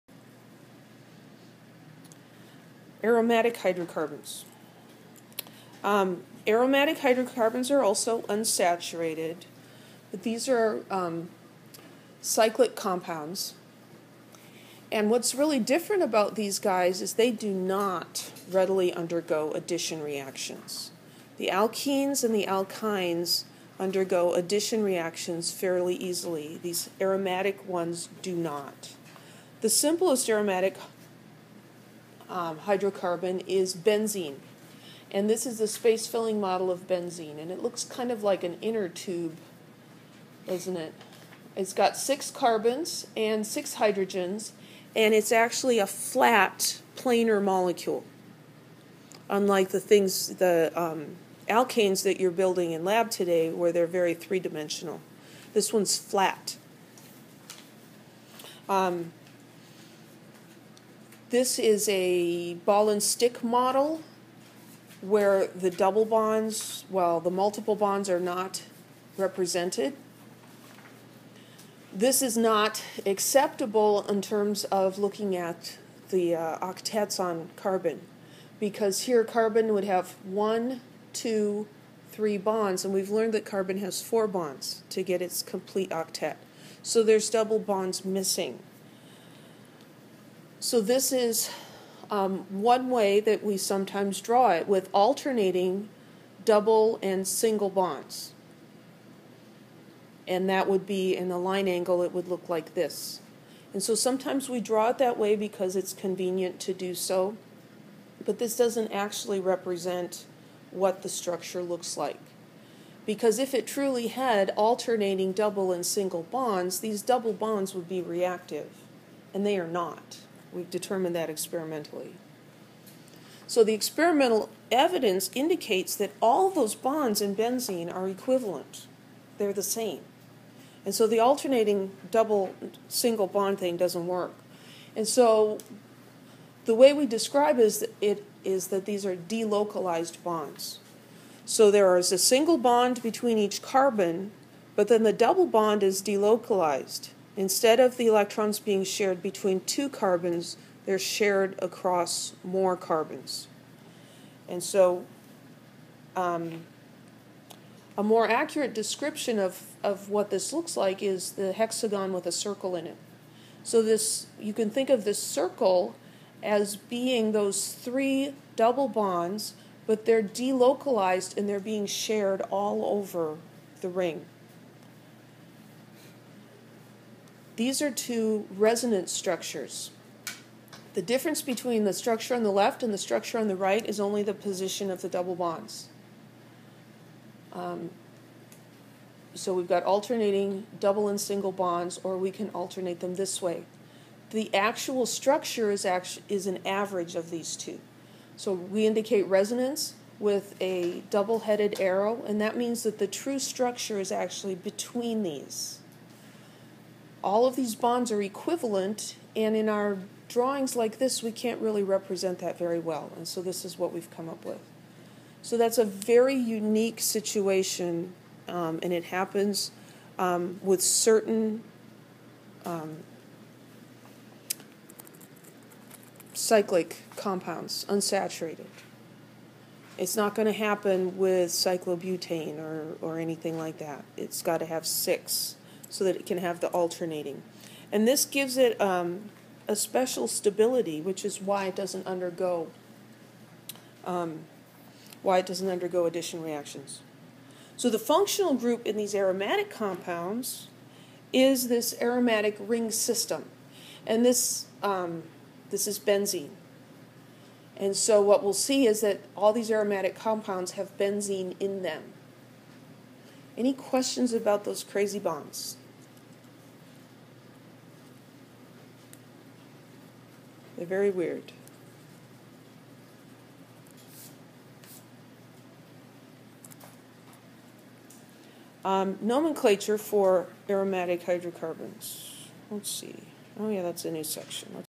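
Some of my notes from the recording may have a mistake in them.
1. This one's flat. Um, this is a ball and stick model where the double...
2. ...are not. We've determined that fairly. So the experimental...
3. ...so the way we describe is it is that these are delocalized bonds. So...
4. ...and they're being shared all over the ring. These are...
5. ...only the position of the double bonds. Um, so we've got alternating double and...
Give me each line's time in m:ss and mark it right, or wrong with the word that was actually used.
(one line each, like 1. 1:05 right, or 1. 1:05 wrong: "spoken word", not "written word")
1. 0:55 right
2. 1:59 wrong: "experimentally", not "fairly"
3. 2:15 right
4. 2:51 right
5. 3:03 right.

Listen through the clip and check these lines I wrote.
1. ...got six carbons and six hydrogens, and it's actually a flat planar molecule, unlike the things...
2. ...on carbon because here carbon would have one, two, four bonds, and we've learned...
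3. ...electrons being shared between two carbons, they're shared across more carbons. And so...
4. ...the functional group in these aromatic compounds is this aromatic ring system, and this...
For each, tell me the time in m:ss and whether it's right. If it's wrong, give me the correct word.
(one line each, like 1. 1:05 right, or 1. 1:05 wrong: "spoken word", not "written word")
1. 0:41 right
2. 1:17 wrong: "three", not "four"
3. 2:28 right
4. 4:07 right.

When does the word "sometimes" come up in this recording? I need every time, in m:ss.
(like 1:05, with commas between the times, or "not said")
1:33, 1:43.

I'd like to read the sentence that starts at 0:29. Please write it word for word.
The simplest aromatic um, hydrocarbon is benzene.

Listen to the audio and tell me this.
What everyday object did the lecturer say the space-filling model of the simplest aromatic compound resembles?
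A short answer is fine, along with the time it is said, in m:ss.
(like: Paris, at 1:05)
An inner tube, at 0:38.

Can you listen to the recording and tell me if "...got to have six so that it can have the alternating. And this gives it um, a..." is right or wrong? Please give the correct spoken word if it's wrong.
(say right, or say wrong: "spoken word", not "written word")
right.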